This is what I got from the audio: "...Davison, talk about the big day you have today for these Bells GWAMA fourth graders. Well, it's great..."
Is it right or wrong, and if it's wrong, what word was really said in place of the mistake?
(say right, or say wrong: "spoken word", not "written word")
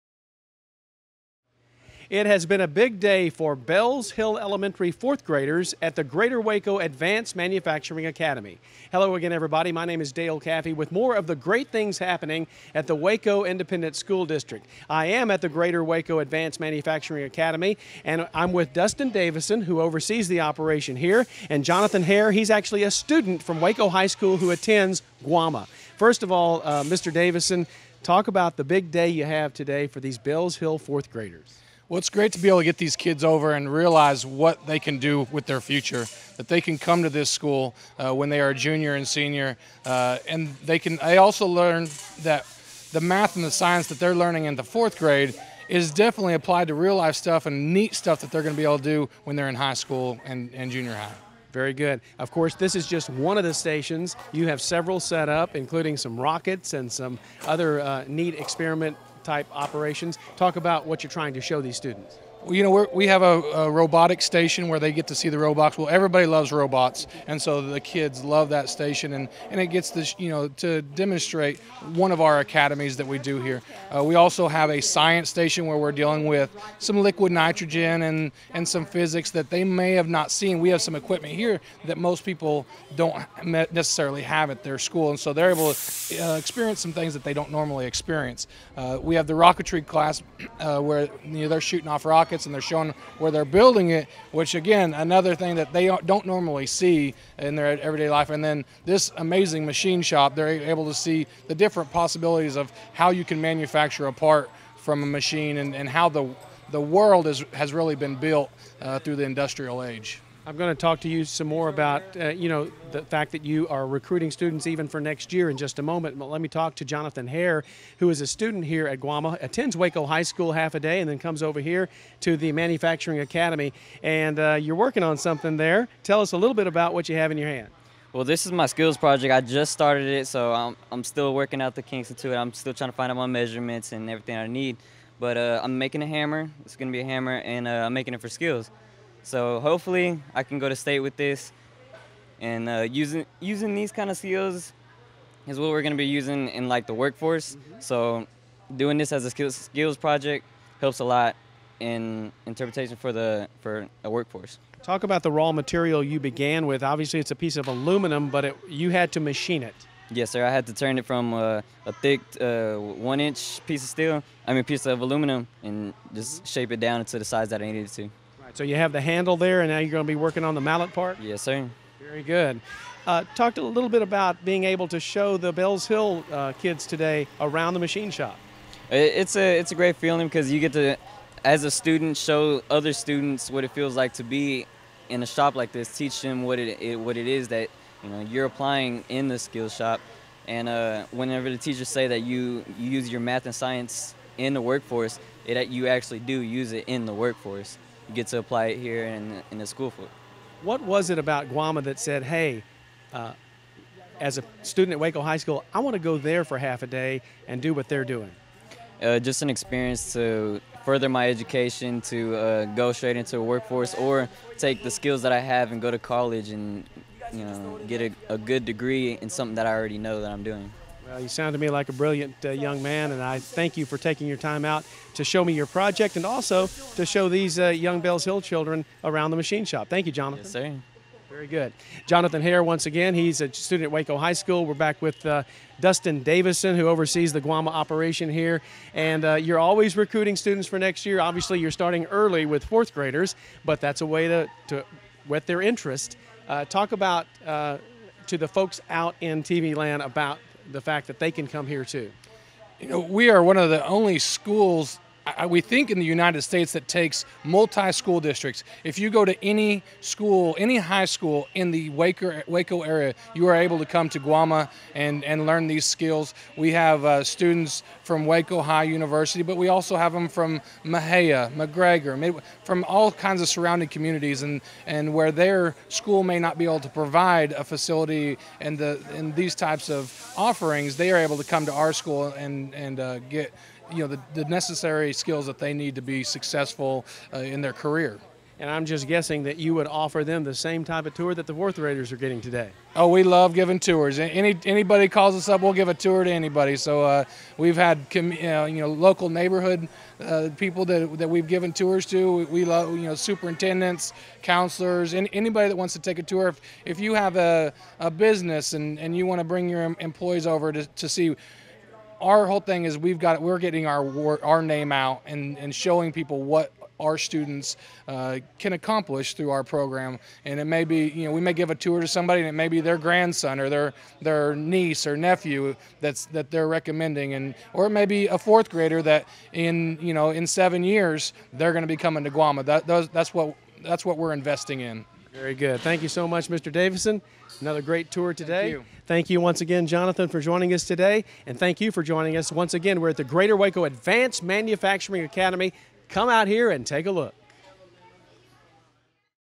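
wrong: "Hill", not "GWAMA".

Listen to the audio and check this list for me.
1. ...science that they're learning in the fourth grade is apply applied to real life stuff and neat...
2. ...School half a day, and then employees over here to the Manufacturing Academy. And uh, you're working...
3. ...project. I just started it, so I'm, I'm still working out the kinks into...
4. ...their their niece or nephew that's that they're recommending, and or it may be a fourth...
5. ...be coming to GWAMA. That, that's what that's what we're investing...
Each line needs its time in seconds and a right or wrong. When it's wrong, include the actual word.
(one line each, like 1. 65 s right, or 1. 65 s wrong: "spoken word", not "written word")
1. 43 s wrong: "definitely", not "apply"
2. 120 s wrong: "comes", not "employees"
3. 128 s right
4. 323 s right
5. 331 s right.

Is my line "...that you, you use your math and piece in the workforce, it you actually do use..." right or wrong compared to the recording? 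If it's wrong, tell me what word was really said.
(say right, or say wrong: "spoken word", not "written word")
wrong: "science", not "piece".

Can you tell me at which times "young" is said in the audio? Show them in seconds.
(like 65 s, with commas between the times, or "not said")
222 s, 227 s.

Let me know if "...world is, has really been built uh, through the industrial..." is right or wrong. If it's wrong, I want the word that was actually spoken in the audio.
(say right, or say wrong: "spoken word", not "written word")
right.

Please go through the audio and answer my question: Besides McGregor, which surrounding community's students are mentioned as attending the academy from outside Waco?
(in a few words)
Mexia.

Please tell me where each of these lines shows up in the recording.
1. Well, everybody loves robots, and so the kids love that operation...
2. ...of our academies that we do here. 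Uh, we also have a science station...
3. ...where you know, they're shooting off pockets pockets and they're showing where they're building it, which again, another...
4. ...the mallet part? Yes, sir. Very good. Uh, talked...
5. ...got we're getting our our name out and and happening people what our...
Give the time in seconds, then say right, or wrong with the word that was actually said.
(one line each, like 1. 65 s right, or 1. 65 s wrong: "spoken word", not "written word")
1. 65 s wrong: "station", not "operation"
2. 72 s right
3. 90 s wrong: "rockets", not "pockets"
4. 170 s right
5. 313 s wrong: "showing", not "happening".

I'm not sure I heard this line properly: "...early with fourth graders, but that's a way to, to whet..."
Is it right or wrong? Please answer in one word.
right.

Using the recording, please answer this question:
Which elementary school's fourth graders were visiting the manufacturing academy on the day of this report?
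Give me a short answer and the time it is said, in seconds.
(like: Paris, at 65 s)
Bells Hill Elementary, at 3 s.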